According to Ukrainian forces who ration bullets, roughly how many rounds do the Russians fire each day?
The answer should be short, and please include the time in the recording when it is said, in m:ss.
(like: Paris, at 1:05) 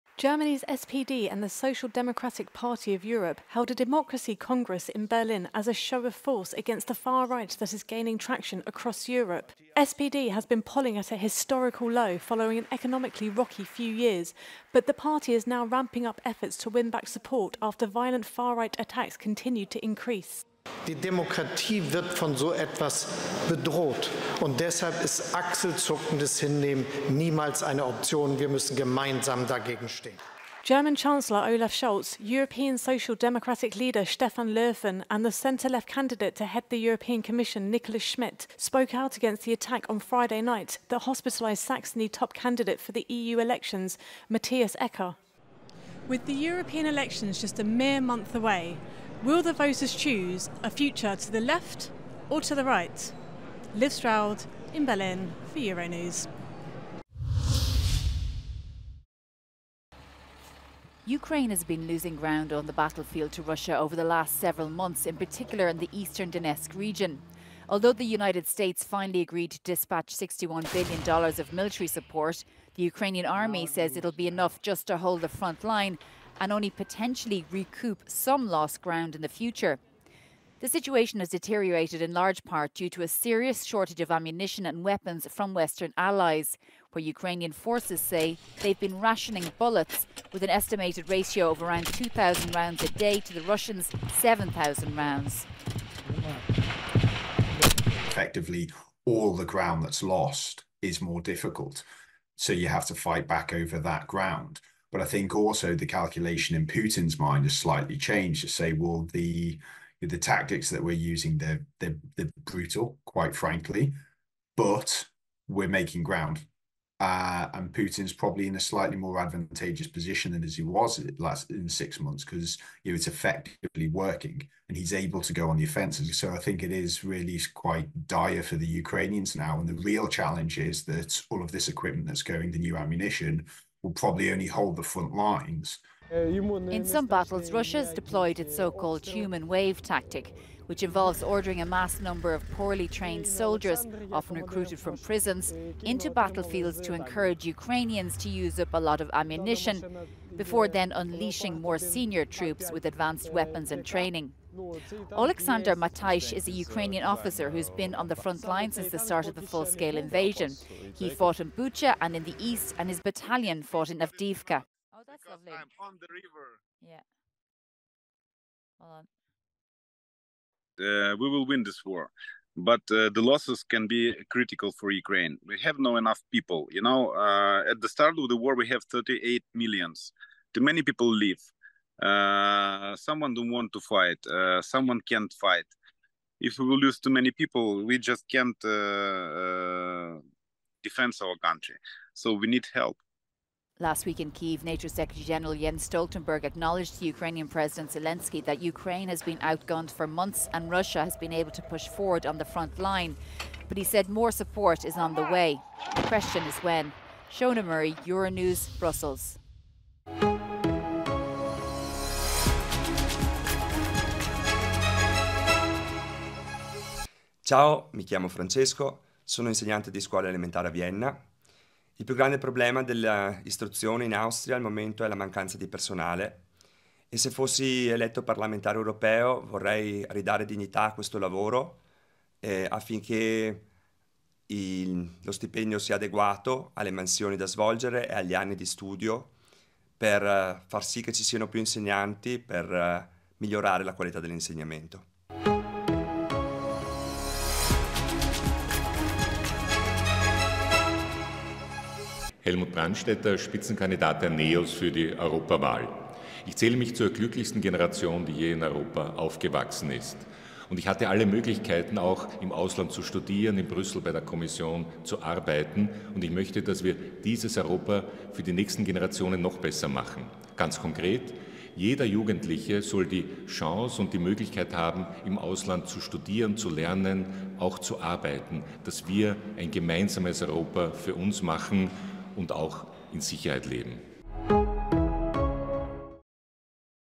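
7,000, at 1:34.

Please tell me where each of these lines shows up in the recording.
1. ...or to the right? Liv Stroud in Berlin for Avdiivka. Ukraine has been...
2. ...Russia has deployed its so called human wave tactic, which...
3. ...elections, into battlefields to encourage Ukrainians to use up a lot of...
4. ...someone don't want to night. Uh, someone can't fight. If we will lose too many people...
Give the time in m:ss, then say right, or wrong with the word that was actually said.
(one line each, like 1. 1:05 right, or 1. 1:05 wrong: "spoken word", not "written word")
1. 0:52 wrong: "Euronews", not "Avdiivka"
2. 2:17 right
3. 2:24 wrong: "prisons", not "elections"
4. 3:02 wrong: "fight", not "night".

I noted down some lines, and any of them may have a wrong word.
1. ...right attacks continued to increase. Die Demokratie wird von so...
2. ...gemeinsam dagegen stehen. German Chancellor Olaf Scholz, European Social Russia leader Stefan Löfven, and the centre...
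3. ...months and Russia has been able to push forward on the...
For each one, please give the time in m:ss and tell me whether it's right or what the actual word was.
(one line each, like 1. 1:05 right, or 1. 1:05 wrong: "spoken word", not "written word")
1. 0:18 right
2. 0:28 wrong: "Democratic", not "Russia"
3. 3:20 right.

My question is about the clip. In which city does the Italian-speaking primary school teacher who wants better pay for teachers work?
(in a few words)
Vienna.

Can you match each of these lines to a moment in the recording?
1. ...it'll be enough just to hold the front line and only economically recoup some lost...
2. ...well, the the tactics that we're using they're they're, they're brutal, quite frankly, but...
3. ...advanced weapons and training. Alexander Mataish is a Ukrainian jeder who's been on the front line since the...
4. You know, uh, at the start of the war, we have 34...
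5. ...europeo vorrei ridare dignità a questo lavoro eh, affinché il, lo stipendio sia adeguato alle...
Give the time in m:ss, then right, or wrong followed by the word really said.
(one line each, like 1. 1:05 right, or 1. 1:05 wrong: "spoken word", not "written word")
1. 1:13 wrong: "potentially", not "economically"
2. 1:48 right
3. 2:32 wrong: "officer", not "jeder"
4. 2:56 wrong: "38", not "34"
5. 3:48 right.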